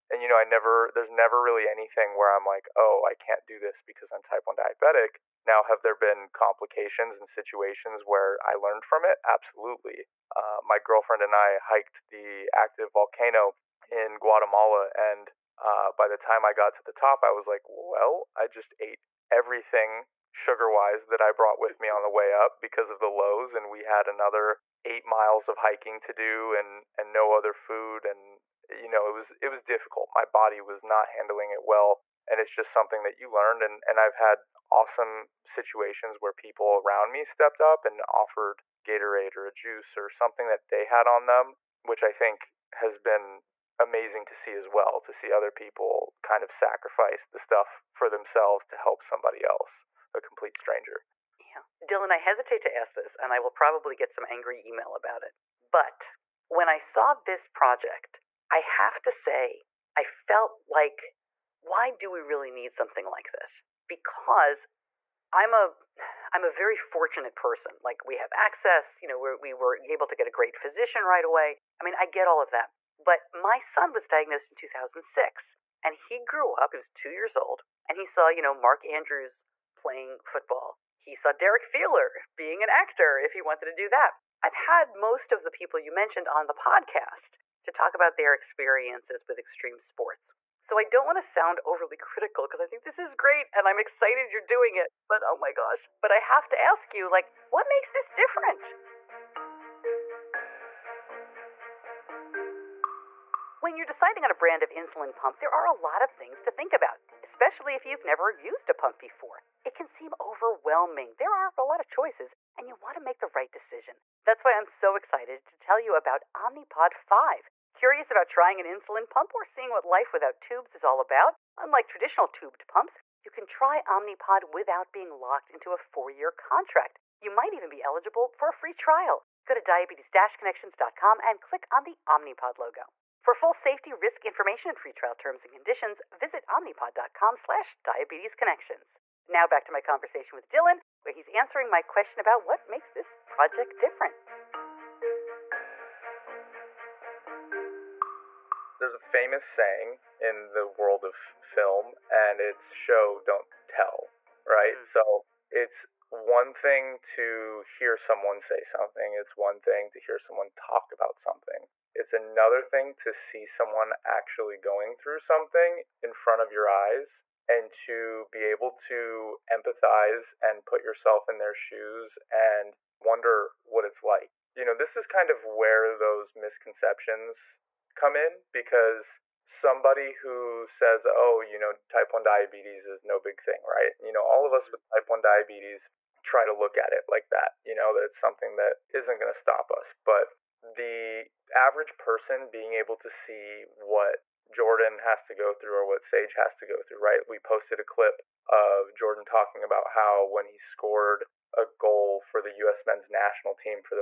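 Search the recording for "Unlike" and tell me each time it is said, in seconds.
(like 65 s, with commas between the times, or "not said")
121 s.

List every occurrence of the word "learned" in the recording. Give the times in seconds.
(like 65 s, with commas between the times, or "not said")
8 s, 33 s.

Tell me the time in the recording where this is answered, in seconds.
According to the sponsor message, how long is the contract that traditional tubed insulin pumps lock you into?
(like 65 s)
125 s.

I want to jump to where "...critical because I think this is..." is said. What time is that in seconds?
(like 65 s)
91 s.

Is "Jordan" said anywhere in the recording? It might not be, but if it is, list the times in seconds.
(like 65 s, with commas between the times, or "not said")
194 s, 198 s.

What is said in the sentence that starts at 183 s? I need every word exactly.
You know, all of us mm-hmm.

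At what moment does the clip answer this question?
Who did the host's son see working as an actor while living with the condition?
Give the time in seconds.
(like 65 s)
81 s.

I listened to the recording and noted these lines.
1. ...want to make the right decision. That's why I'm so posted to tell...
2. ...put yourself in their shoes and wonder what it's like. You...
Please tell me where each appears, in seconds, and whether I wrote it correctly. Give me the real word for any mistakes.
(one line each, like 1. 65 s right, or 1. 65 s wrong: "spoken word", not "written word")
1. 112 s wrong: "excited", not "posted"
2. 170 s right.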